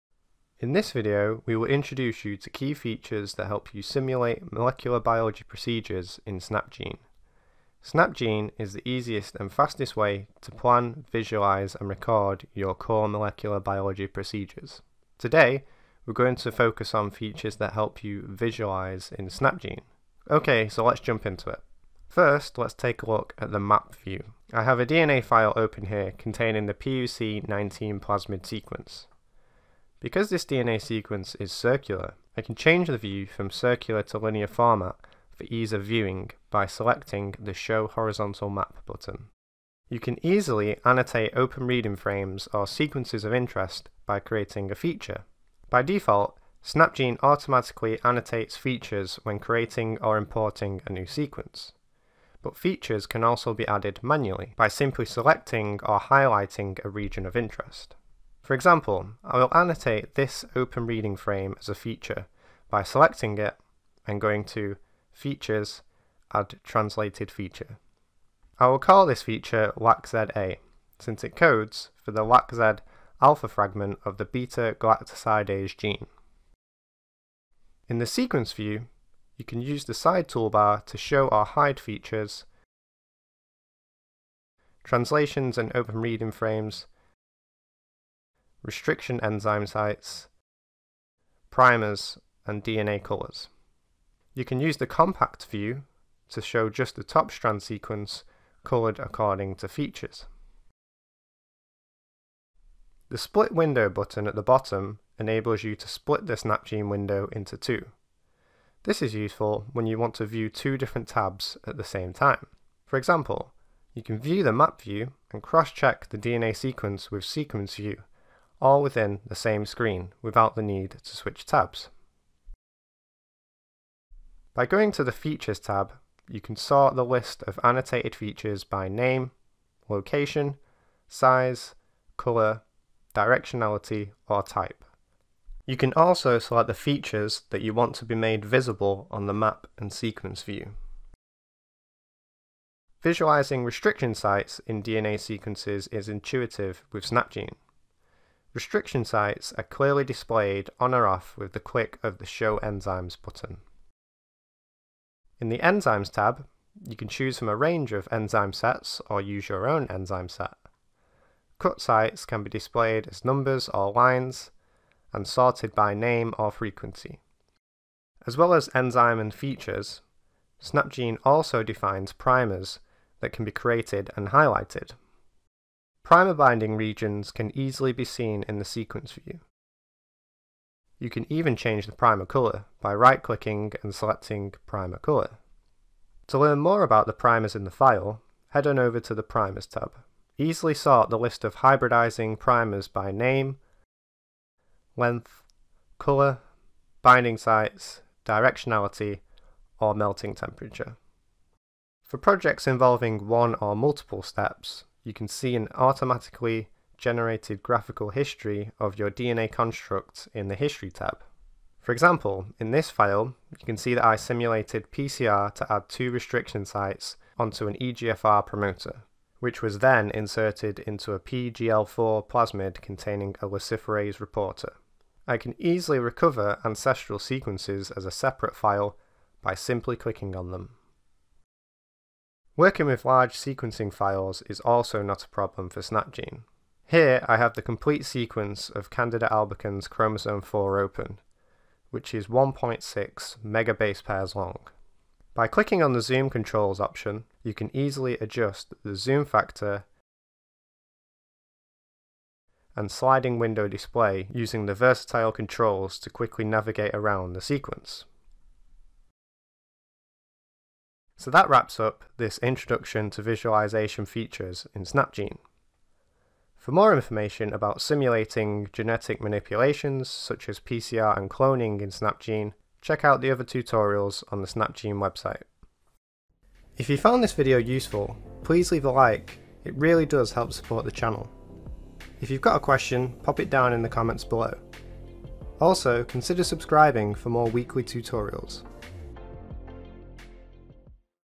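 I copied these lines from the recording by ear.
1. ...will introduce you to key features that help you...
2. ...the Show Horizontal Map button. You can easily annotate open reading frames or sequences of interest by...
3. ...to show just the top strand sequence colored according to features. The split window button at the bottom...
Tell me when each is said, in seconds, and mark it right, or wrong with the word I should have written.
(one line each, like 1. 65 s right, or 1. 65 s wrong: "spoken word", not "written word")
1. 1 s right
2. 37 s right
3. 96 s right.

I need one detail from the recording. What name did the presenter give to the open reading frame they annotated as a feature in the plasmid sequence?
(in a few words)
LACZA.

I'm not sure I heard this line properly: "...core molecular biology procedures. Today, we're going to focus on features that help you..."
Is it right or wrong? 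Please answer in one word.
right.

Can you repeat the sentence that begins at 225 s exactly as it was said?
I can easily recover ancestral sequences as a separate file by simply clicking on them.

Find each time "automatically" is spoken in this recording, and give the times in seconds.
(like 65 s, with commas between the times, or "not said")
47 s, 205 s.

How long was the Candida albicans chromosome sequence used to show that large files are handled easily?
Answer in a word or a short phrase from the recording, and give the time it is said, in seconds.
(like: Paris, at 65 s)
1.6 megabase pairs, at 242 s.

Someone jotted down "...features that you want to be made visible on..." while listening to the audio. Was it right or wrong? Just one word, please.
right.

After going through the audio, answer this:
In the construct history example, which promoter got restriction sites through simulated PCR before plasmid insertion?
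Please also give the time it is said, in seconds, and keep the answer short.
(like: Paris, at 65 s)
EGFR promoter, at 217 s.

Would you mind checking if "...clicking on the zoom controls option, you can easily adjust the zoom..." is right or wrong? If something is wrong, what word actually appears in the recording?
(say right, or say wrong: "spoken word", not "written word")
right.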